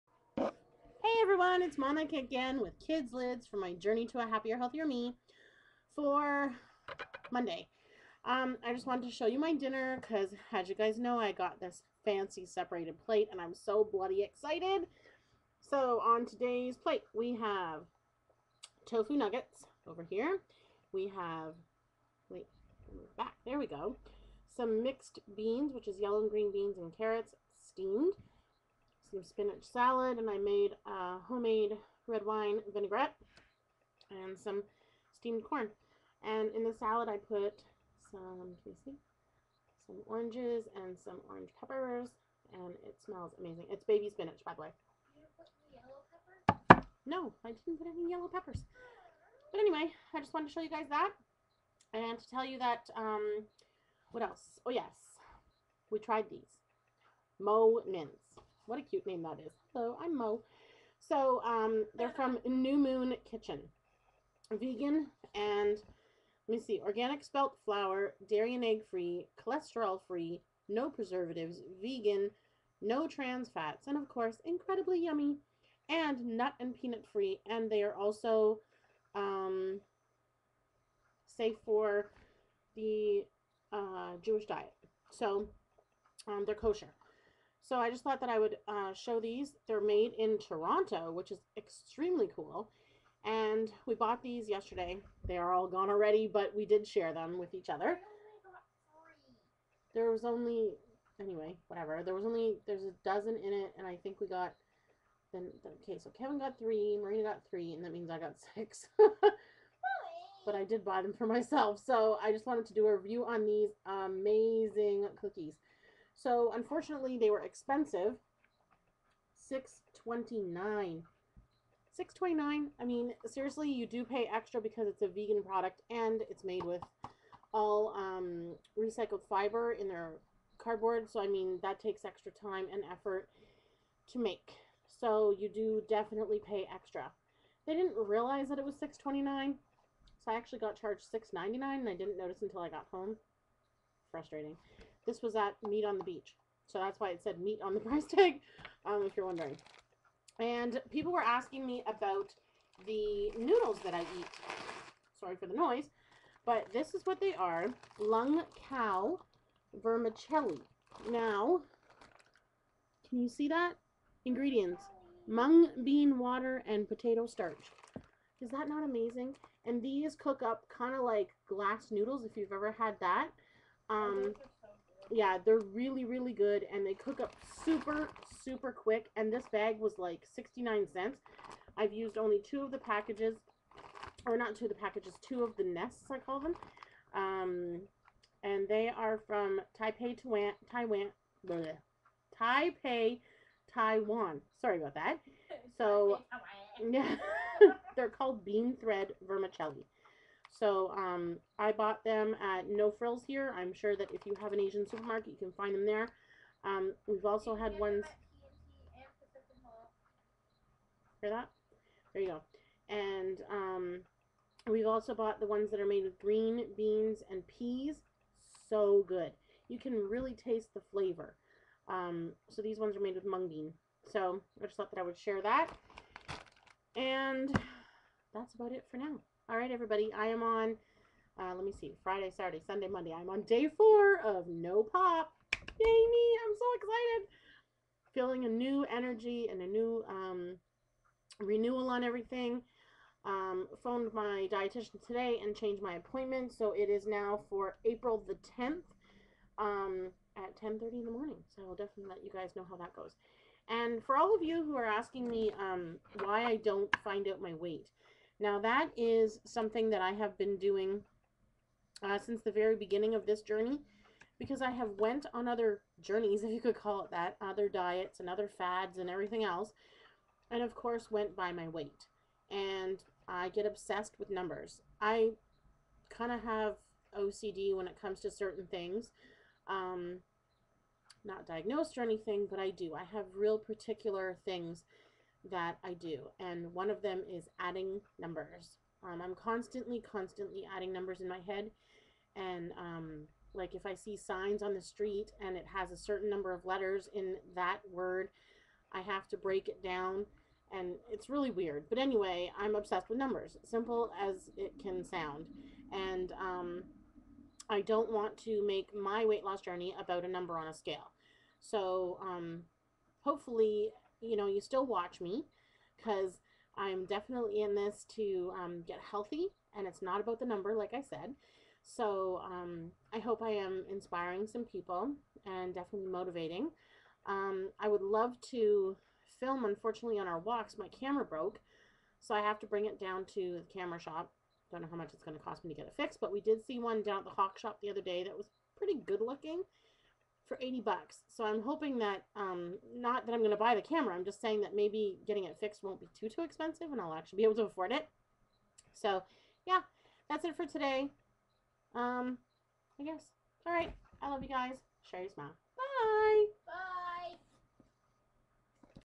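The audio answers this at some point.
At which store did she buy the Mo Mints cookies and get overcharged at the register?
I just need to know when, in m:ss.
2:25.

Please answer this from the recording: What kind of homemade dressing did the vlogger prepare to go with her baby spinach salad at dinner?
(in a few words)
Red wine vinaigrette.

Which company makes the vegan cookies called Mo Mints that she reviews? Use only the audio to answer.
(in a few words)
New Moon Kitchen.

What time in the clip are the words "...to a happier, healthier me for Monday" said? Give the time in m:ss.
0:04.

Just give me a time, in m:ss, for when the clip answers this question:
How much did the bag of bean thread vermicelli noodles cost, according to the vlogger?
3:00.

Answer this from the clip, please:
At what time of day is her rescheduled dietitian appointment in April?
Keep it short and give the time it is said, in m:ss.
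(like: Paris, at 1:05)
10:30 a.m., at 4:10.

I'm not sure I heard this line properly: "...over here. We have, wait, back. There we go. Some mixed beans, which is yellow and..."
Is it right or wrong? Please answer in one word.
right.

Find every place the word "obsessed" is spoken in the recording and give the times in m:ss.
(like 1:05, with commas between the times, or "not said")
4:33, 5:02.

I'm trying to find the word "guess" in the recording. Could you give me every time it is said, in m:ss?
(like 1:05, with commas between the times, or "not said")
5:53.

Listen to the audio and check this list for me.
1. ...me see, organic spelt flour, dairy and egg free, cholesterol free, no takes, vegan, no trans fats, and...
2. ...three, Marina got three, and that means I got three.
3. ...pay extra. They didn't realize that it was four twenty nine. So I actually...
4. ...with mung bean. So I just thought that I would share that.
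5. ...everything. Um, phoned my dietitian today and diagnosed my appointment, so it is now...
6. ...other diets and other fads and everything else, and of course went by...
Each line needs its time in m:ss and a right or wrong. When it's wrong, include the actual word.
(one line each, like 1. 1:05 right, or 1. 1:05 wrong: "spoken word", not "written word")
1. 1:06 wrong: "preservatives", not "takes"
2. 1:46 wrong: "six", not "three"
3. 2:16 wrong: "six", not "four"
4. 3:43 right
5. 4:02 wrong: "changed", not "diagnosed"
6. 4:27 right.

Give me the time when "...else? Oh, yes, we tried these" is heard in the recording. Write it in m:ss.
0:54.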